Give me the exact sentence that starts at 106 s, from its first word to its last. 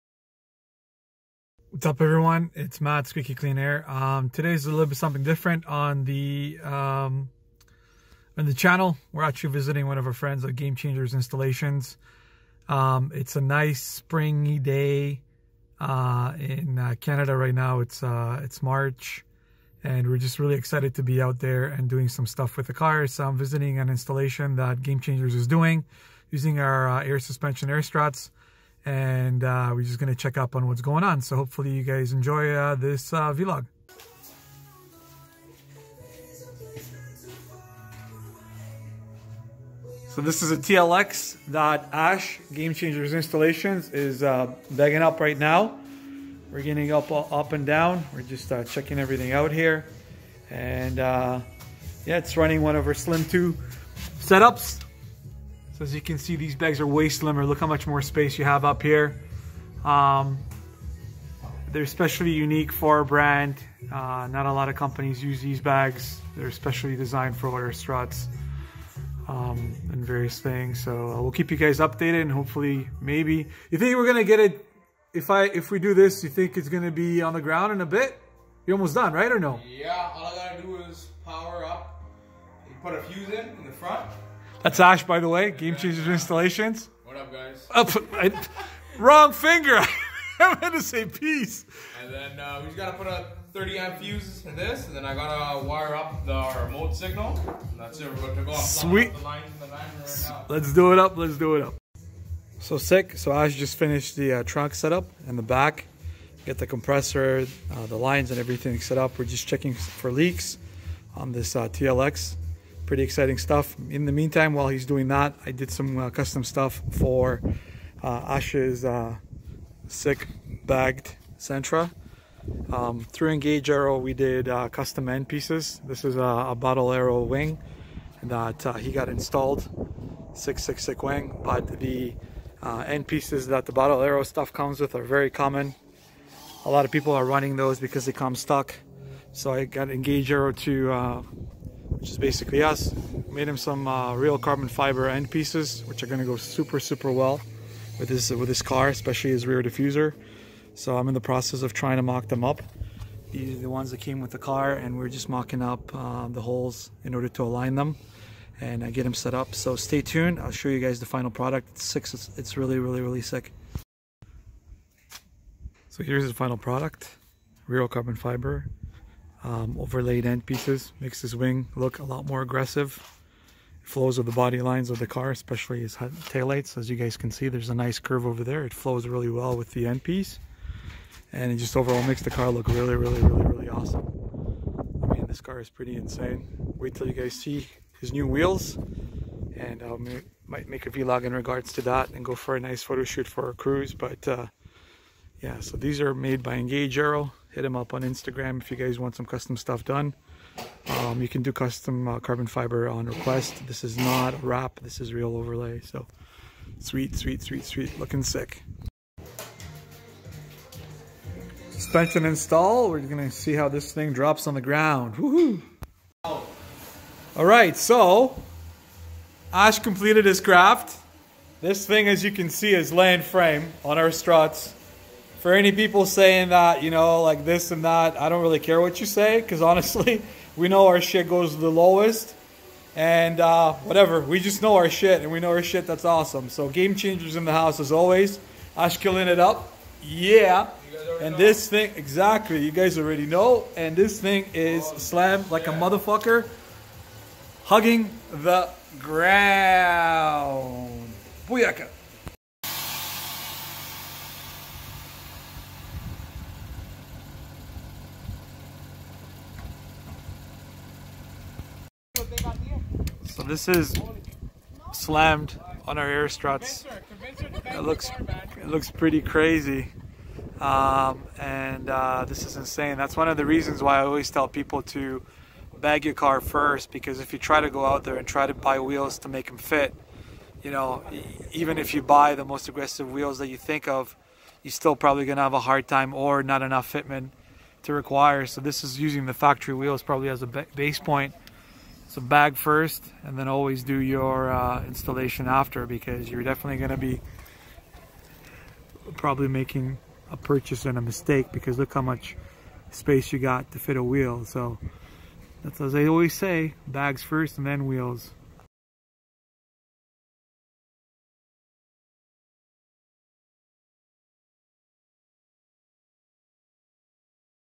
Get the compressor, uh, the lines, and everything set up.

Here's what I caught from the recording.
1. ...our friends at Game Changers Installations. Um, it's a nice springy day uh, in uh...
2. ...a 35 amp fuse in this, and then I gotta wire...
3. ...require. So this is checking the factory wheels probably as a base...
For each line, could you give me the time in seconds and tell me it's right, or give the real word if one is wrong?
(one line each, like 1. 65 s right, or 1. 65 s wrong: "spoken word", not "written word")
1. 10 s right
2. 93 s wrong: "30", not "35"
3. 287 s wrong: "using", not "checking".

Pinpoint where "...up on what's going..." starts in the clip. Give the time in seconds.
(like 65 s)
30 s.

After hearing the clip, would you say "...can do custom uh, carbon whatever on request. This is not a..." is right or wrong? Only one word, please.
wrong.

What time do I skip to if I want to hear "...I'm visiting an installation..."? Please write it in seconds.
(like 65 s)
23 s.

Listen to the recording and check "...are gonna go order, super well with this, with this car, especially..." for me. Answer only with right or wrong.
wrong.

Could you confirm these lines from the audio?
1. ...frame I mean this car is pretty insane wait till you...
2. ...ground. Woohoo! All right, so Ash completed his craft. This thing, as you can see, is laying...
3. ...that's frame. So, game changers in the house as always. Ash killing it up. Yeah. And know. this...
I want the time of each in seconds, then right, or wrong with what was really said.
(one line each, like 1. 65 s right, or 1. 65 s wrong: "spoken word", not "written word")
1. 183 s wrong: "awesome", not "frame"
2. 214 s right
3. 235 s wrong: "awesome", not "frame".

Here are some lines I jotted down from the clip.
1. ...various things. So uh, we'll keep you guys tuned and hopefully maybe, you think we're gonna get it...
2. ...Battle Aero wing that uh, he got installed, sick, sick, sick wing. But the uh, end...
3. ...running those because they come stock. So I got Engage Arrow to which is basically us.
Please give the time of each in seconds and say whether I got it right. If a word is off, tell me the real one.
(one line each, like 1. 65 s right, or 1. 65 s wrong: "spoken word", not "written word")
1. 70 s wrong: "updated", not "tuned"
2. 126 s right
3. 137 s right.